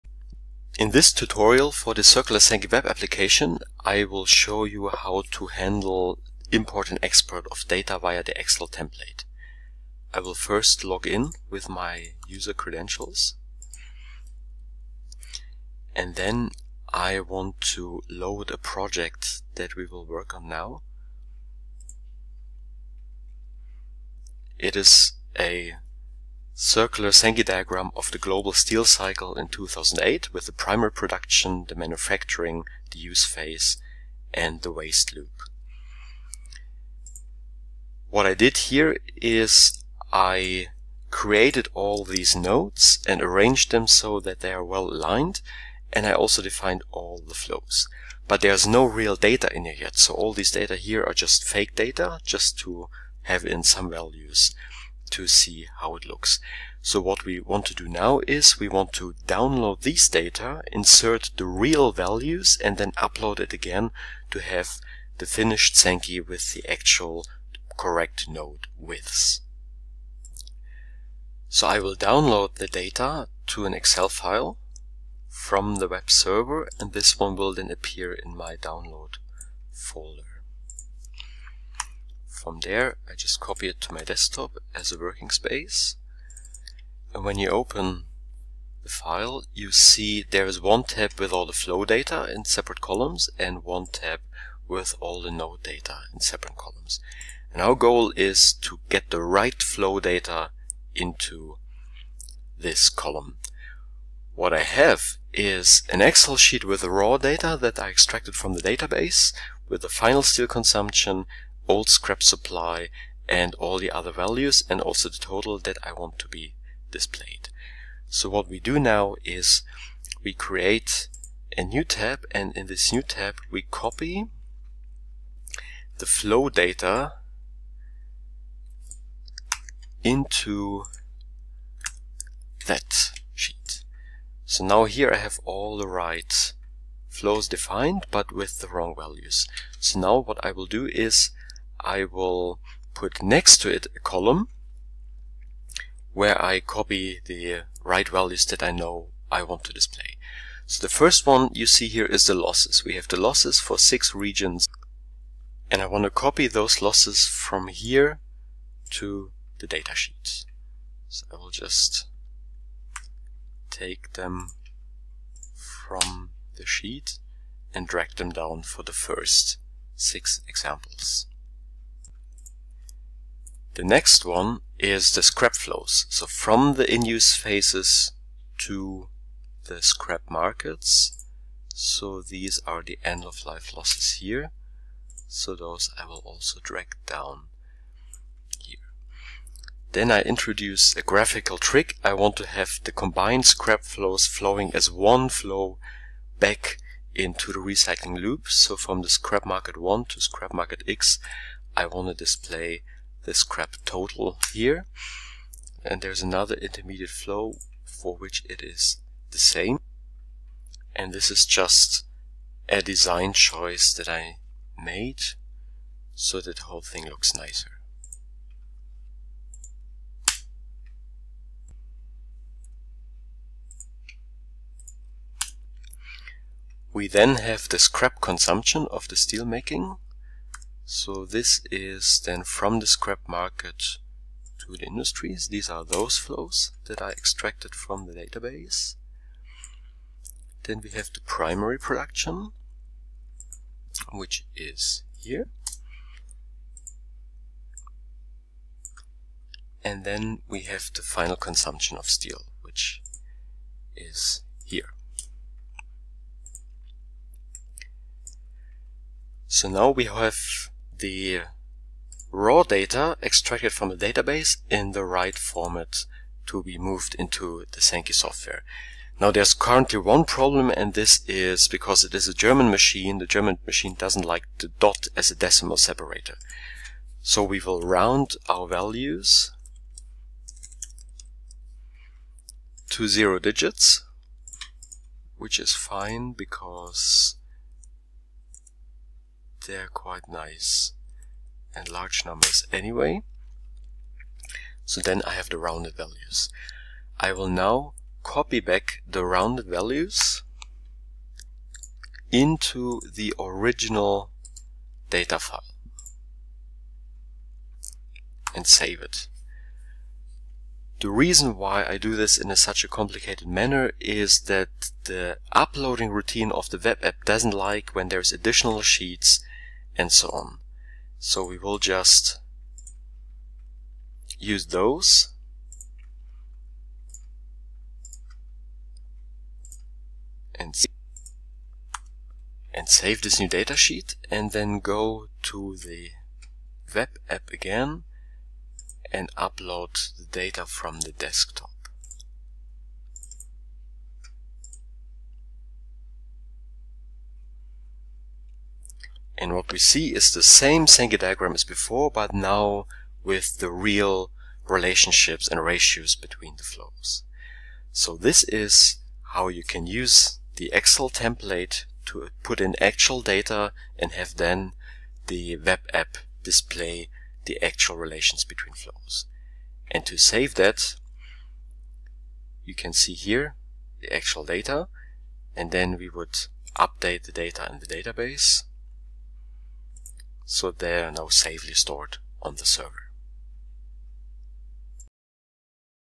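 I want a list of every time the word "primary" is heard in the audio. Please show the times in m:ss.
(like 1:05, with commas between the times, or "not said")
0:30, 4:01.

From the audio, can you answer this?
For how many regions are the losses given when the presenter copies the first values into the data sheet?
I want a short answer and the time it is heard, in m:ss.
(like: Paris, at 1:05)
6, at 2:33.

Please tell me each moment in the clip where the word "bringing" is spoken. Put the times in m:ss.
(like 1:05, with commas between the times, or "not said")
not said.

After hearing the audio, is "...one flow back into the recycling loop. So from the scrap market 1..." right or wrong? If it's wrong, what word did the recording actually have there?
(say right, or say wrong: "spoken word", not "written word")
right.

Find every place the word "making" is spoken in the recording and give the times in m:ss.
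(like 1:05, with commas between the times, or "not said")
3:49.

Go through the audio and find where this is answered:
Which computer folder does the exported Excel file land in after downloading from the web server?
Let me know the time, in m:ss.
1:18.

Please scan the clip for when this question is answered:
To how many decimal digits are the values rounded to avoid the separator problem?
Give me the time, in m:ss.
4:43.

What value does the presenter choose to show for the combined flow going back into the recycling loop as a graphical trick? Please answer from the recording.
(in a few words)
scrap total.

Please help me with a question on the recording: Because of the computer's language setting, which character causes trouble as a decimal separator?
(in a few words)
dot.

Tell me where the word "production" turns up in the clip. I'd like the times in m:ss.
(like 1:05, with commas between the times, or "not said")
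0:30, 4:01.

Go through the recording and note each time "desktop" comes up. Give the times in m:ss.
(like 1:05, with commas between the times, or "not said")
1:24, 5:41.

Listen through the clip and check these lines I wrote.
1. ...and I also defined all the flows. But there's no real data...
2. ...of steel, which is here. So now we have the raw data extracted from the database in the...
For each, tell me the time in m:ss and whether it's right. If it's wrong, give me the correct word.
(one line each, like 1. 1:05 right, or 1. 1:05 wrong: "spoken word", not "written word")
1. 0:45 right
2. 4:11 right.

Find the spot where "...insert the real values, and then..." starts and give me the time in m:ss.
1:00.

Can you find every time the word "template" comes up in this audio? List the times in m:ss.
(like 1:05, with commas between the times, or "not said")
0:08, 6:01.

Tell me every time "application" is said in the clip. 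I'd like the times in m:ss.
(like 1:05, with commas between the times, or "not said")
0:02.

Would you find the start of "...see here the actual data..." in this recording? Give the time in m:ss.
6:12.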